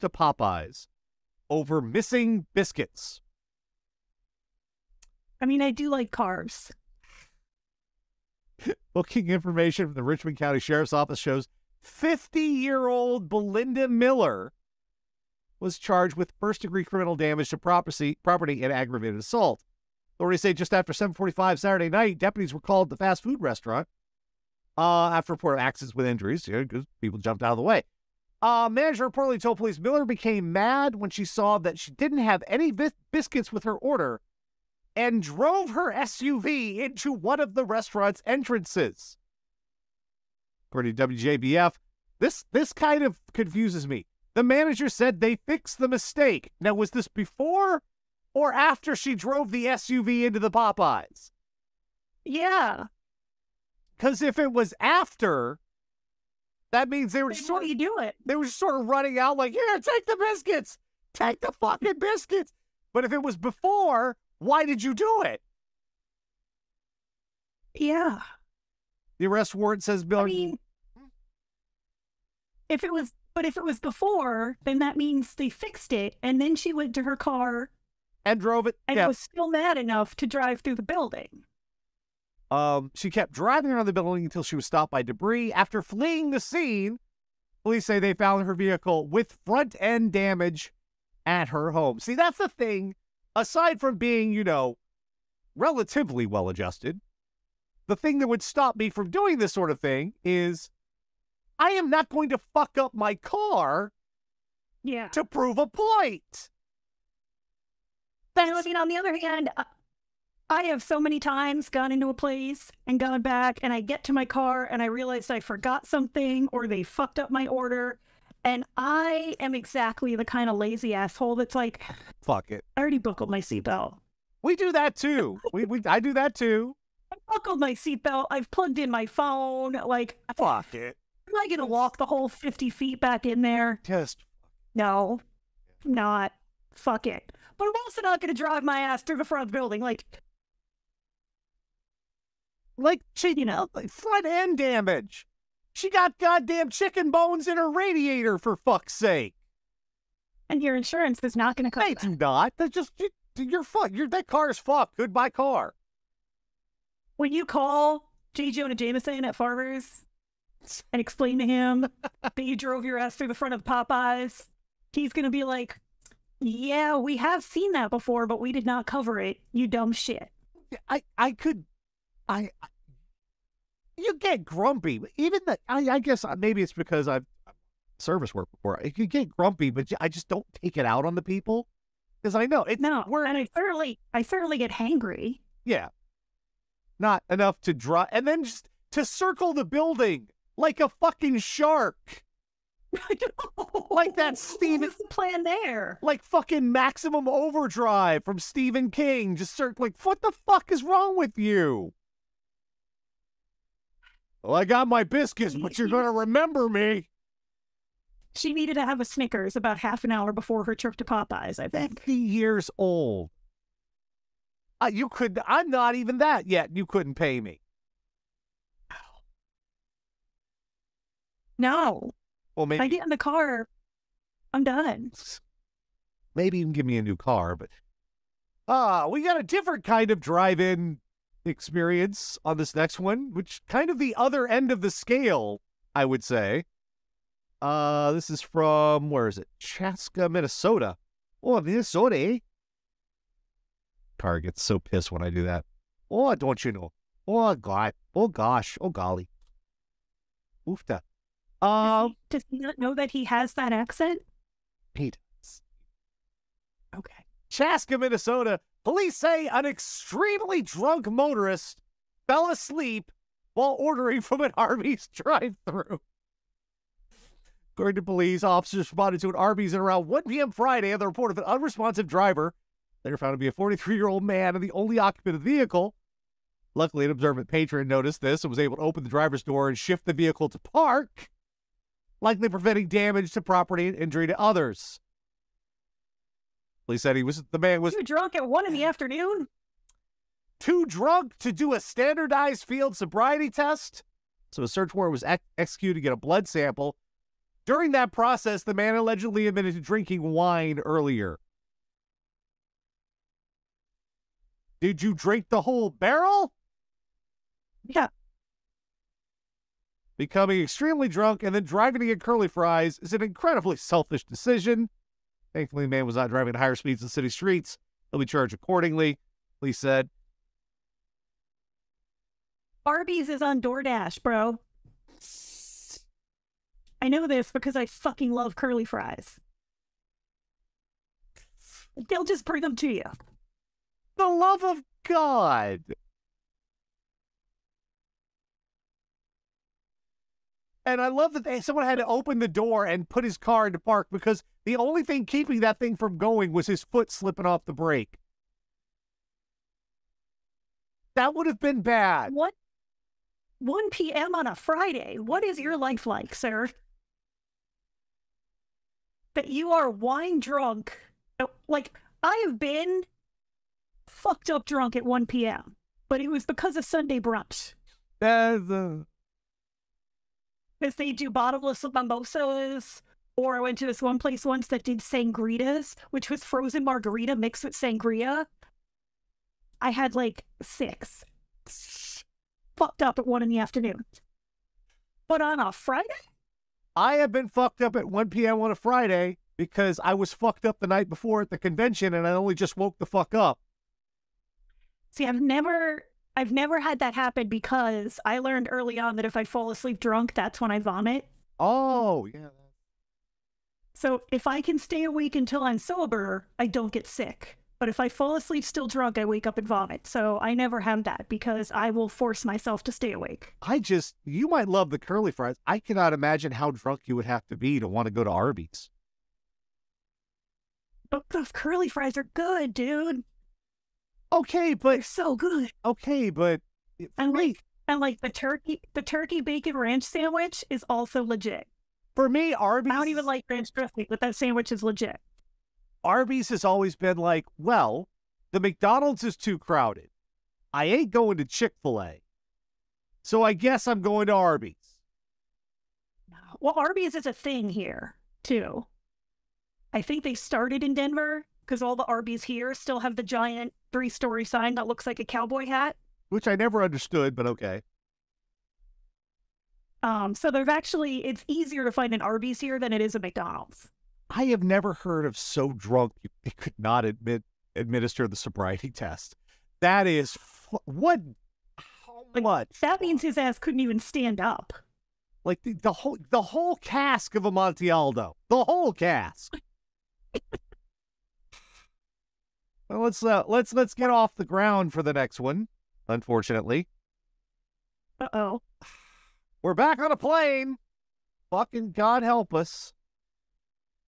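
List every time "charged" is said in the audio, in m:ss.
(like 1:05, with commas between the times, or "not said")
0:15, 5:18.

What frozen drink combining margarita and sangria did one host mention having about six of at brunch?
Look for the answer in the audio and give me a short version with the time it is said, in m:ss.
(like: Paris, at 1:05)
Sangritas, at 6:14.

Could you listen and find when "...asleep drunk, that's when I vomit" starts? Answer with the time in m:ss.
6:39.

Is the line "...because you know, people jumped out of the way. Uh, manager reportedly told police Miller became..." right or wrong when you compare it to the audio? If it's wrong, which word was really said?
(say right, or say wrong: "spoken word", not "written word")
right.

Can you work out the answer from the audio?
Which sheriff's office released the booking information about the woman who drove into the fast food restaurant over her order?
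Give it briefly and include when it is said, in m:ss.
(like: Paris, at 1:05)
Richmond County, at 0:10.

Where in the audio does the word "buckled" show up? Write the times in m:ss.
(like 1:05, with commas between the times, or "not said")
2:02, 2:07.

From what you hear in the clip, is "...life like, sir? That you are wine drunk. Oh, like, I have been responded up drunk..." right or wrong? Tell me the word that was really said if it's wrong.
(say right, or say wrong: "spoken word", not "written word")
wrong: "fucked", not "responded".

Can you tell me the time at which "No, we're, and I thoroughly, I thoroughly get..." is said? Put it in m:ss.
3:02.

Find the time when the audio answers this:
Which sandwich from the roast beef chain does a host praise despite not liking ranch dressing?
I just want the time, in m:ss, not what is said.
7:09.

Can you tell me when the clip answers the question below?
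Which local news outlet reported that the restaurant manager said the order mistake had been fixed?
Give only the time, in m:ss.
0:41.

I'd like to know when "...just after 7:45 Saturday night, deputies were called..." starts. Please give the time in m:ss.
0:20.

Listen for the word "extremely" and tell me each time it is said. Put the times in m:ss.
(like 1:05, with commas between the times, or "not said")
4:19, 5:10.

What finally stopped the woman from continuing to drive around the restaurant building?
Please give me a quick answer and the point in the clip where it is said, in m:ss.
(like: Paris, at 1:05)
Debris, at 1:25.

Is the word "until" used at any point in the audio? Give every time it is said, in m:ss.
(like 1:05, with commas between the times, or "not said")
1:24, 6:45.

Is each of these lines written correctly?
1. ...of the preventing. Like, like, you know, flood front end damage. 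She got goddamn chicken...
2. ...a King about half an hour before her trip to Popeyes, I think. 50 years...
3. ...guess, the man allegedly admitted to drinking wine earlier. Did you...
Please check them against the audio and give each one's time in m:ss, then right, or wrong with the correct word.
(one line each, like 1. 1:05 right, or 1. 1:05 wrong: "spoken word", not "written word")
1. 2:19 wrong: "building", not "preventing"
2. 3:29 wrong: "Snickers", not "King"
3. 4:58 wrong: "process", not "guess".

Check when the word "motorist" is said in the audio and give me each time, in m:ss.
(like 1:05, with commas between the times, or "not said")
4:21.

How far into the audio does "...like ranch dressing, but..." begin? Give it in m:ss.
7:13.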